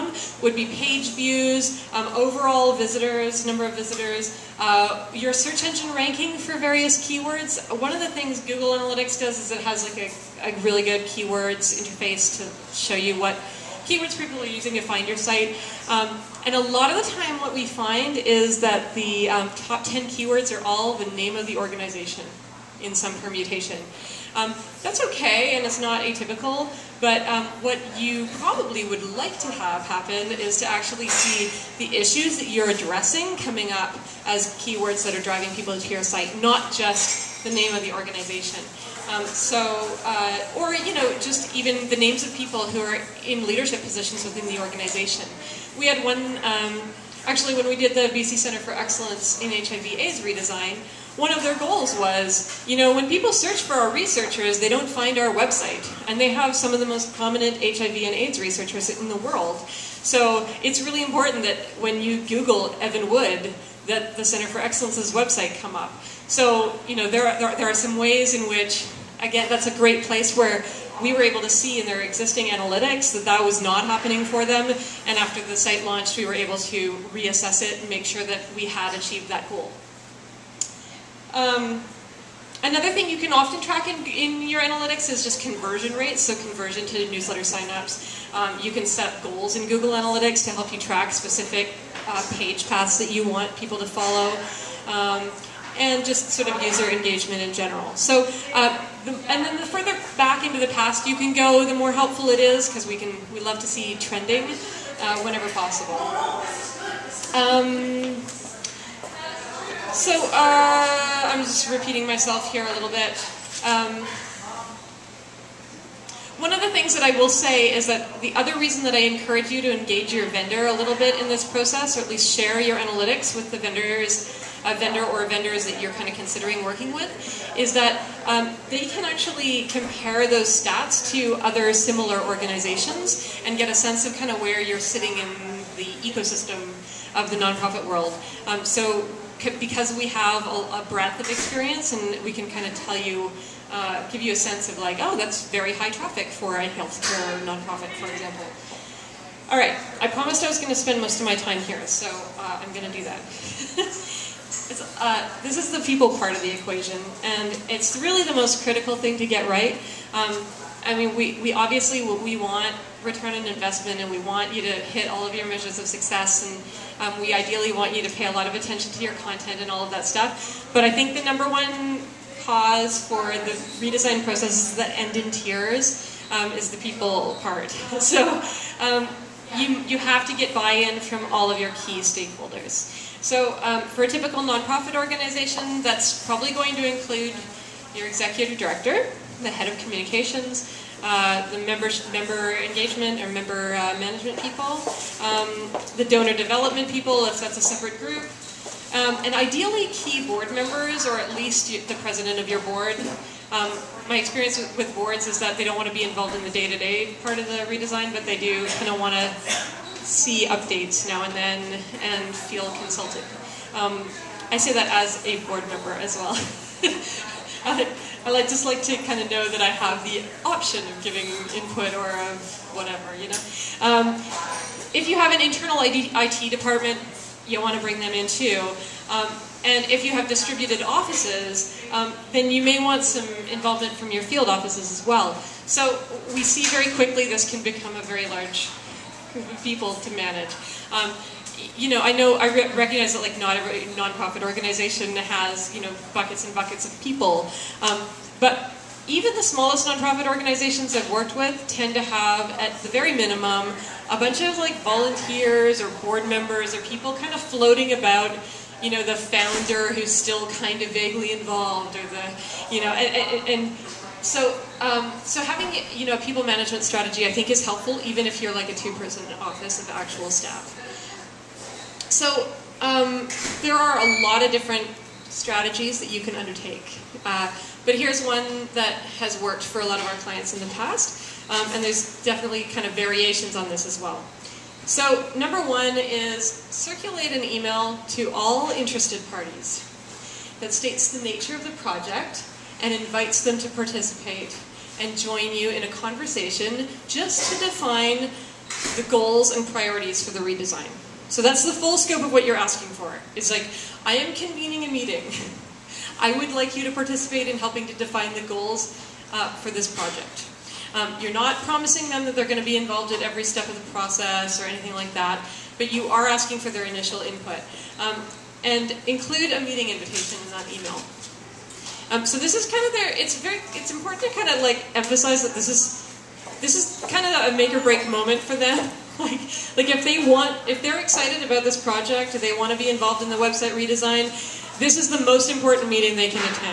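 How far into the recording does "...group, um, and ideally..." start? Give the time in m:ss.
3:17.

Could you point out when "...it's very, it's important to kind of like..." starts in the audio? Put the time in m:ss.
5:23.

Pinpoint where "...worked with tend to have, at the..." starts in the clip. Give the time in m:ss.
4:11.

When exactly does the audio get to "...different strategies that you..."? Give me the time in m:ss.
4:34.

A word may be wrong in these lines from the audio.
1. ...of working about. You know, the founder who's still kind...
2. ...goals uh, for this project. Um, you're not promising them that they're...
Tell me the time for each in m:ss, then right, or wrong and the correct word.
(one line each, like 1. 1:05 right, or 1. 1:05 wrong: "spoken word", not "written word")
1. 4:17 wrong: "floating", not "working"
2. 5:08 right.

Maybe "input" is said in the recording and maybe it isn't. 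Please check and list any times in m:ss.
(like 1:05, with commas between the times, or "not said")
3:41, 5:17.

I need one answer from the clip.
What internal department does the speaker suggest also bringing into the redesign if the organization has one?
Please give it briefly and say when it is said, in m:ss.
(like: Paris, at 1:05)
IT department, at 3:45.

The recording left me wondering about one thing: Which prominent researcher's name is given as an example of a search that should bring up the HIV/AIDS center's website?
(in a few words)
Evan Wood.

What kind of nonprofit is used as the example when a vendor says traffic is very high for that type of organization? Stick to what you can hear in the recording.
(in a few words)
healthcare nonprofit.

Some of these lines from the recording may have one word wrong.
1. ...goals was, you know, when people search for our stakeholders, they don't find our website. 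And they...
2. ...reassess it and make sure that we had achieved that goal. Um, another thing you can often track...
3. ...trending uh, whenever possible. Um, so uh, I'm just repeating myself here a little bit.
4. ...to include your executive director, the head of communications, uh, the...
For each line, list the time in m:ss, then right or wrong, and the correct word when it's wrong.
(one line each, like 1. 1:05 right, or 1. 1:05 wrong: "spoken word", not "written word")
1. 0:51 wrong: "researchers", not "stakeholders"
2. 1:17 right
3. 1:44 right
4. 3:06 right.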